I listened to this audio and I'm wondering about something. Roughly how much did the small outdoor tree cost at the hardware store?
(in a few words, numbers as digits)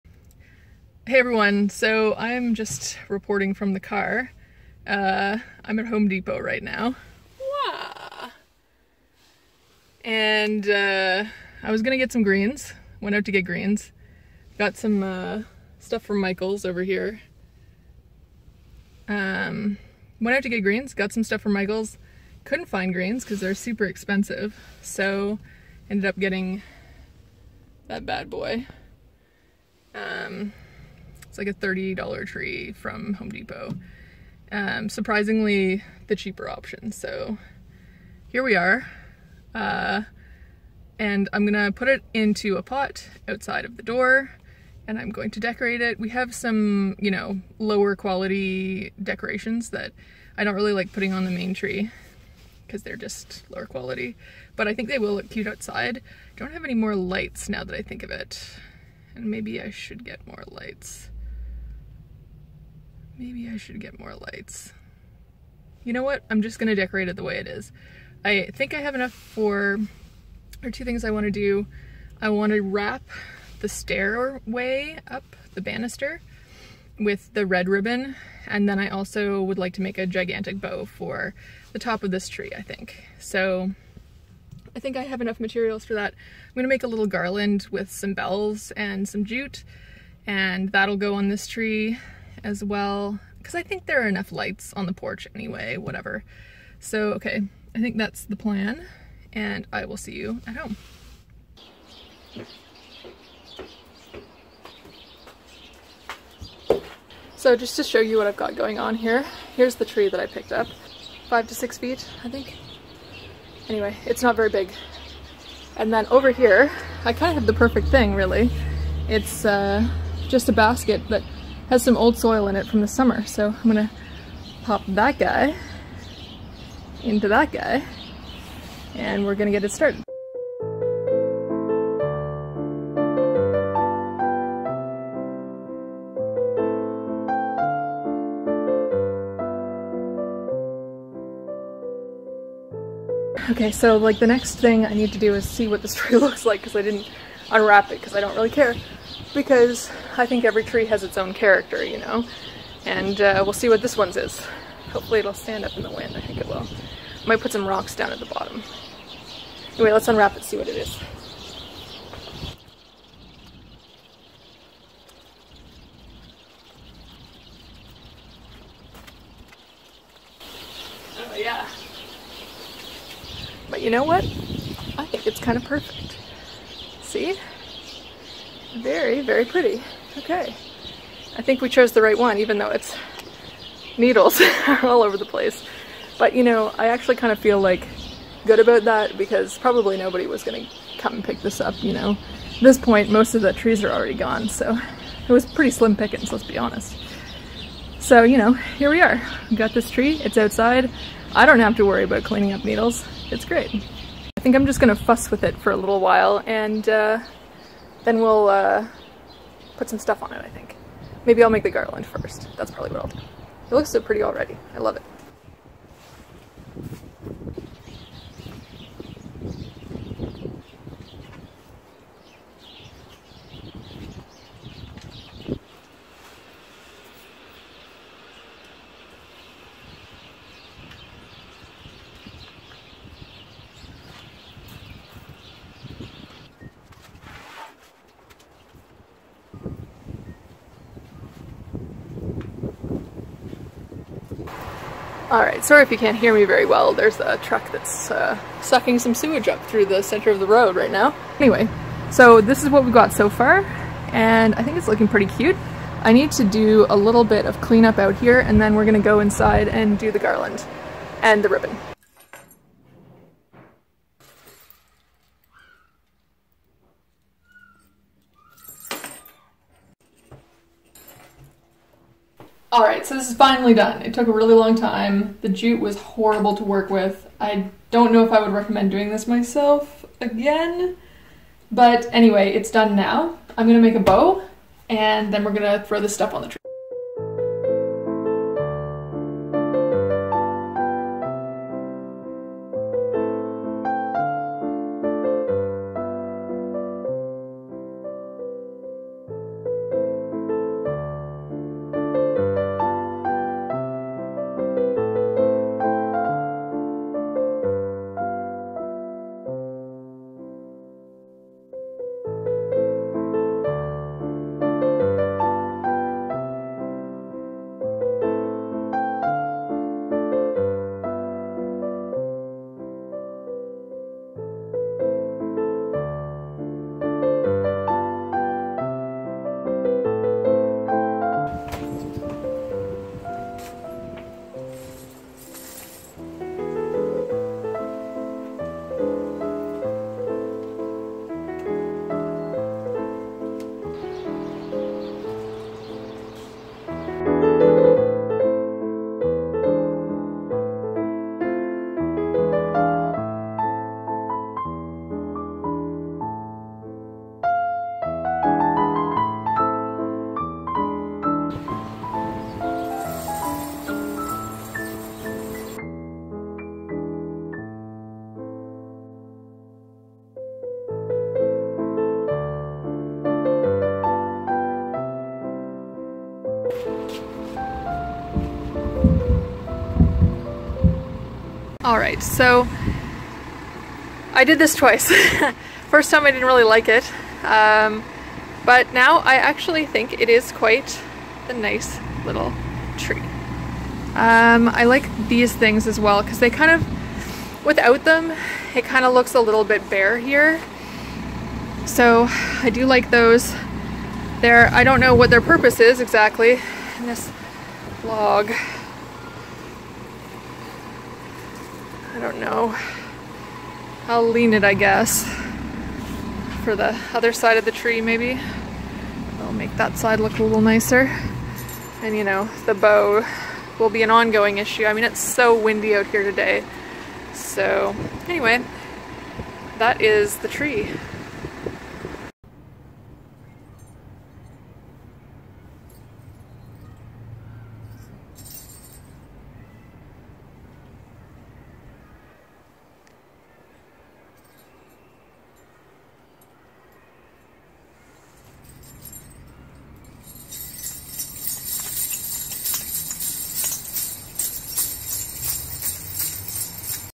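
$30.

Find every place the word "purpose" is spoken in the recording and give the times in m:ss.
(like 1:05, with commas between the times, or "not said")
6:45.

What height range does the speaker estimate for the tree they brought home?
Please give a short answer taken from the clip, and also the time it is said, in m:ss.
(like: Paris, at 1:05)
5 to 6 feet, at 1:51.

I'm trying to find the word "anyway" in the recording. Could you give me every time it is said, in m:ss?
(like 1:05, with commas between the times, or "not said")
1:35, 1:53, 2:39, 4:11, 4:42, 7:08.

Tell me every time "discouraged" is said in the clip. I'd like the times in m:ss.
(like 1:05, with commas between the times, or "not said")
not said.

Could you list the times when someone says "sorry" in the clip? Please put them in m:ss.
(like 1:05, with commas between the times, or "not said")
4:05.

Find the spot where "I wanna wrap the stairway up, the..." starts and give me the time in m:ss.
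1:12.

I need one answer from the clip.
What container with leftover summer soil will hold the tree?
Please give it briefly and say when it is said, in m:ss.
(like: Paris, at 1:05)
A basket, at 2:00.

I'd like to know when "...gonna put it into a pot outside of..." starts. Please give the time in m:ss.
0:41.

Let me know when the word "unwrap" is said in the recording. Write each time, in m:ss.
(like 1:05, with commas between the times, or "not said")
2:27, 2:40.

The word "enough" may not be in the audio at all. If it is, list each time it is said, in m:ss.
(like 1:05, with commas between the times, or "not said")
1:08, 1:25, 1:34.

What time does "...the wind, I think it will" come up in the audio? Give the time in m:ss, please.
2:35.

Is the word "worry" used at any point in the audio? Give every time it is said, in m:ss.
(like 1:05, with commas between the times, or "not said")
3:21.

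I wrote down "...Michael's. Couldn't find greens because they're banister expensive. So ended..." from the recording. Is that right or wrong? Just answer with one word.
wrong.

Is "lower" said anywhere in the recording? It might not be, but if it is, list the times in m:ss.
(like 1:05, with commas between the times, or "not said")
0:47, 0:53.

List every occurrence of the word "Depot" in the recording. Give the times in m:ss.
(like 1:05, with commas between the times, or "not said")
0:06, 0:33.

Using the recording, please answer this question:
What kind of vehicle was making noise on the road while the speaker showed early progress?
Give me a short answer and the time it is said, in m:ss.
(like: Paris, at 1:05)
A truck, at 4:07.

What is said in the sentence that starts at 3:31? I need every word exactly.
Maybe I'll make the garland first.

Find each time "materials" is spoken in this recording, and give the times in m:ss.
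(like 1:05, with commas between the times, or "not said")
1:25.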